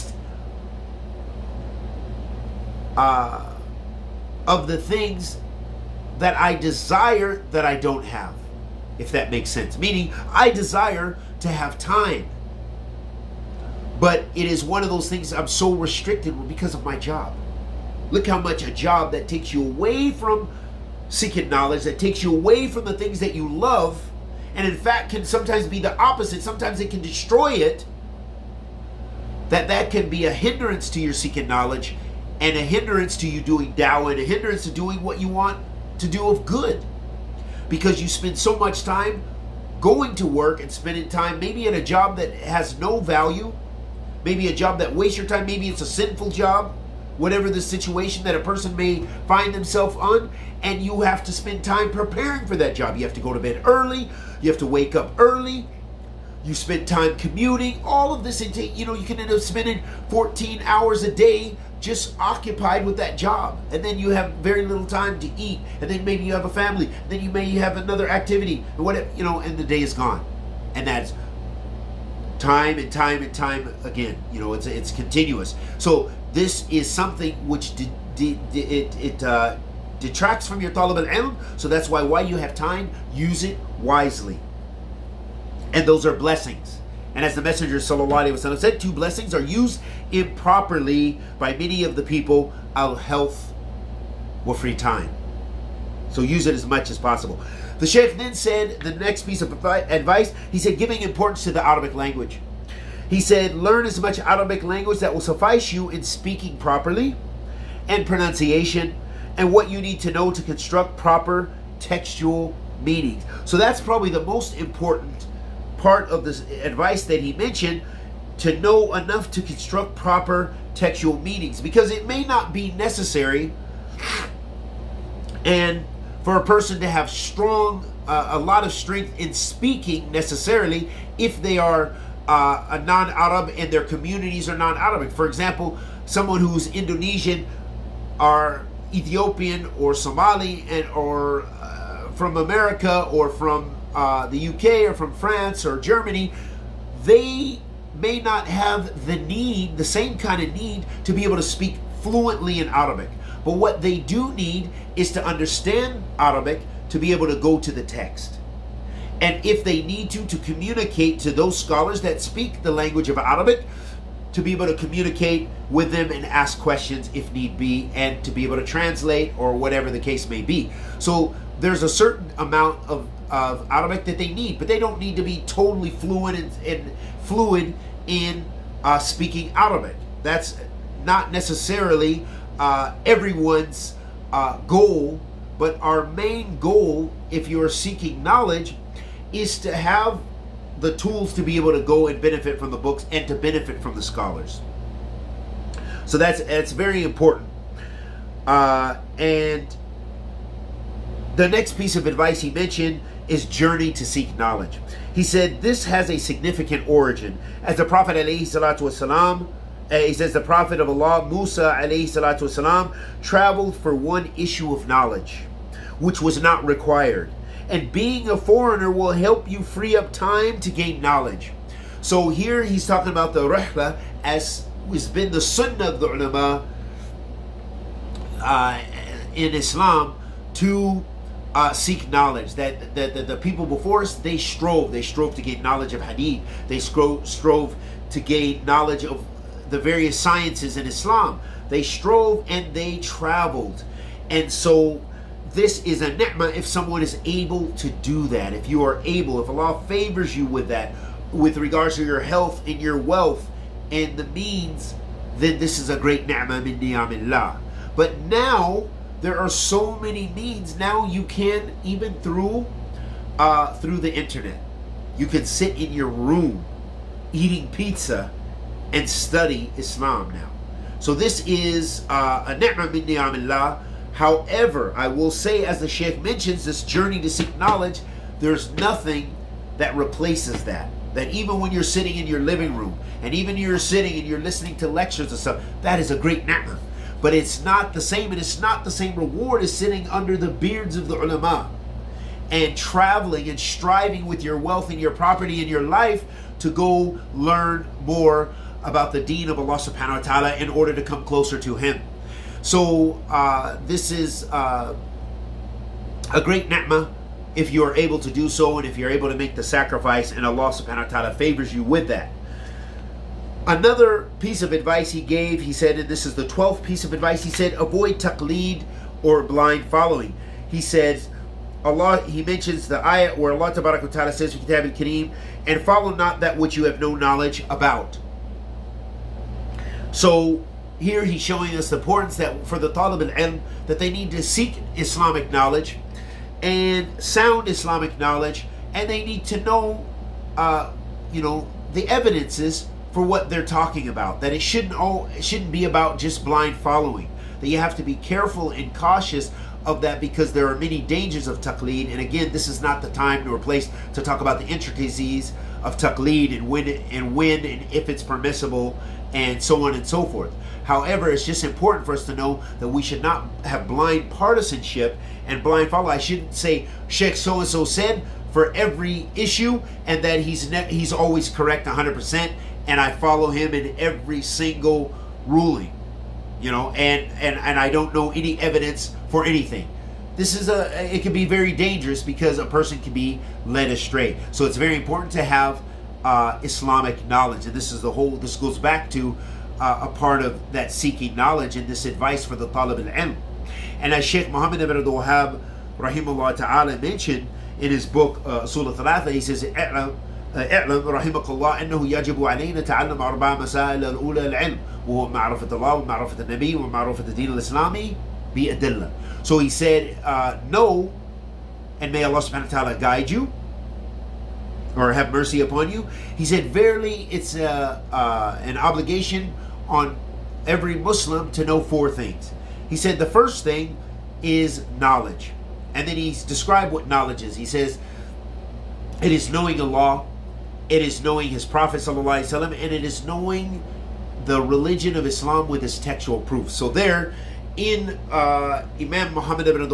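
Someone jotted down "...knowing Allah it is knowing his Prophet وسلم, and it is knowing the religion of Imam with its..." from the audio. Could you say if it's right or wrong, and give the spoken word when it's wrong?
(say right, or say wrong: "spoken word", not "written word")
wrong: "Islam", not "Imam".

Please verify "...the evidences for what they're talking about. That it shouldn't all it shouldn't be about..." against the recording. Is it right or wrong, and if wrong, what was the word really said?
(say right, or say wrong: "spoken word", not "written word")
right.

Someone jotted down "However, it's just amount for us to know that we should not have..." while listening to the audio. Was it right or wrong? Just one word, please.
wrong.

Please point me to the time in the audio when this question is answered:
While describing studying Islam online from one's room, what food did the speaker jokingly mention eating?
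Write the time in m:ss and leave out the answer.
4:27.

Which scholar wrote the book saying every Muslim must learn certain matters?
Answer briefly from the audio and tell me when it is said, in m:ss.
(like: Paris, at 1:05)
Muhammad ibn Abdul Wahhab, at 6:34.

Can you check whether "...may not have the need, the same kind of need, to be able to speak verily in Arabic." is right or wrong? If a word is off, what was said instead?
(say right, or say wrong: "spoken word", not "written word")
wrong: "fluently", not "verily".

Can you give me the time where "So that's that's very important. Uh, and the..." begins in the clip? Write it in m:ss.
3:16.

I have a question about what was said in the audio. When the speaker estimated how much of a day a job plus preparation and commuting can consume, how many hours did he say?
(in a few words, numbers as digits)
14.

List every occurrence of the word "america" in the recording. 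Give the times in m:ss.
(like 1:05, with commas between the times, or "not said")
2:22.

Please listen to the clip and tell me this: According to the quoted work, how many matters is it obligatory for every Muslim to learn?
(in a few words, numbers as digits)
4.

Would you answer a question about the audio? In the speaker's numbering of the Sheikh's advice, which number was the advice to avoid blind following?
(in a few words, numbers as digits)
12th.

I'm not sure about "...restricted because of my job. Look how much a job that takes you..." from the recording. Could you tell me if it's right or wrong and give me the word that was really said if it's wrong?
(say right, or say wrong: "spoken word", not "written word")
right.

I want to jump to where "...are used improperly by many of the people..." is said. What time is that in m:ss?
1:29.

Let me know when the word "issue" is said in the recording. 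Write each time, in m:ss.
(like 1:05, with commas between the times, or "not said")
3:34, 6:09.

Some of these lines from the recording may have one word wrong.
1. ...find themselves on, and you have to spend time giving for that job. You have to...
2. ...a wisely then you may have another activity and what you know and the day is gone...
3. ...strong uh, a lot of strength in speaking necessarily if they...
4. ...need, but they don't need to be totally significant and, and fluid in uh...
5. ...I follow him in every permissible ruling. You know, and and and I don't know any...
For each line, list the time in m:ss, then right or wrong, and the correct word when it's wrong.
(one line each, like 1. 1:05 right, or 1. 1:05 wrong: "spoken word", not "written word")
1. 0:49 wrong: "preparing", not "giving"
2. 1:06 wrong: "family", not "wisely"
3. 2:07 right
4. 2:54 wrong: "fluent", not "significant"
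5. 6:12 wrong: "single", not "permissible".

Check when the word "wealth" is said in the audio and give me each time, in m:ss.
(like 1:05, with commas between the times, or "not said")
4:12, 4:54.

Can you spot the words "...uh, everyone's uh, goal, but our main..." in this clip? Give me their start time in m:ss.
3:02.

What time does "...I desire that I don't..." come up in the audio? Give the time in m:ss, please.
0:06.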